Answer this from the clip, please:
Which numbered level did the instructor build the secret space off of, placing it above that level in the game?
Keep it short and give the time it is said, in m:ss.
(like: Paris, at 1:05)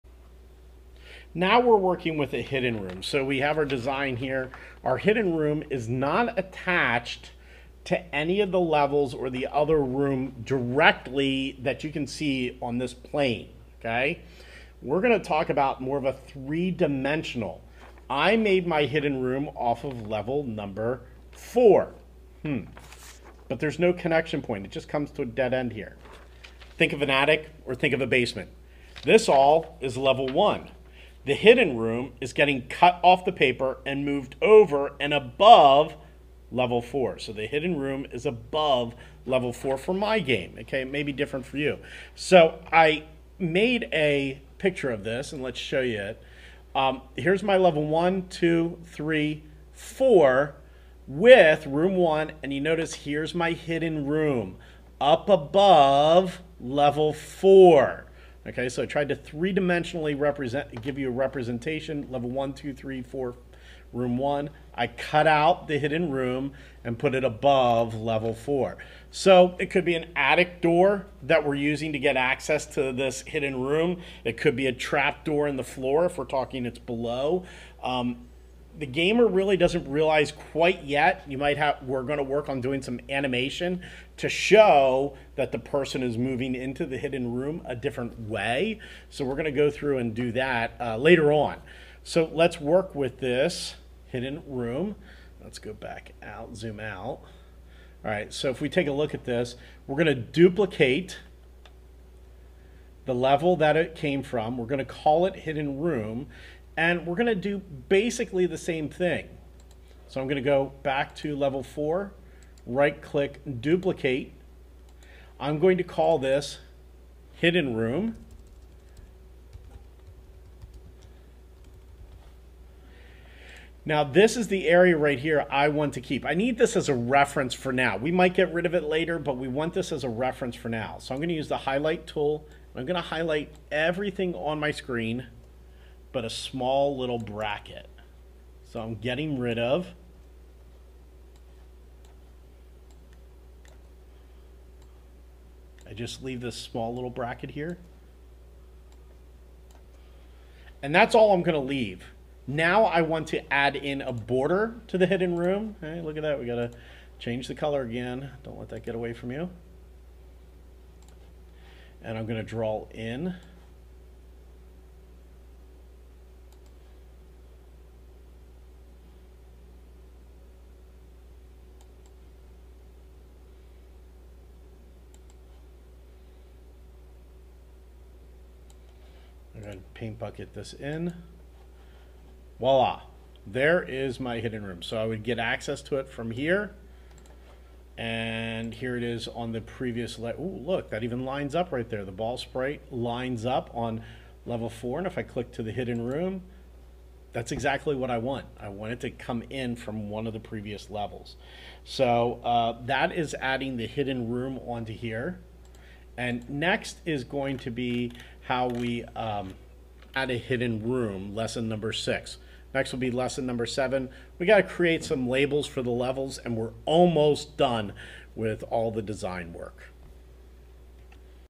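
Level 4, at 0:20.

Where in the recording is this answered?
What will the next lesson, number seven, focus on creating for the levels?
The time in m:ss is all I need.
3:35.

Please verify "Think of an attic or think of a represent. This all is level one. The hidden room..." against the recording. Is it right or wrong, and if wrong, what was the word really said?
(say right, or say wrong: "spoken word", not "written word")
wrong: "basement", not "represent".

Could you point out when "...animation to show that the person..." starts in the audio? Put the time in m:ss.
1:23.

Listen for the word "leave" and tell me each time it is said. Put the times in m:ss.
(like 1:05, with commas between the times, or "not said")
2:26, 2:31.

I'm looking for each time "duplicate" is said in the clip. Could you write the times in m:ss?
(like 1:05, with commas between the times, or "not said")
1:40, 1:53.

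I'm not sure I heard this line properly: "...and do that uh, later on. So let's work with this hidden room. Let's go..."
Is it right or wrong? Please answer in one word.
right.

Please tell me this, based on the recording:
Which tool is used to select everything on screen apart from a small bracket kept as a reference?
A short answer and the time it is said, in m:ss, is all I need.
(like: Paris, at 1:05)
Highlight tool, at 2:11.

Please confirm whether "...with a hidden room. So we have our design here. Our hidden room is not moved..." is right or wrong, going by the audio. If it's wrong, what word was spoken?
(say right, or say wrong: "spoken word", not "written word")
wrong: "attached", not "moved".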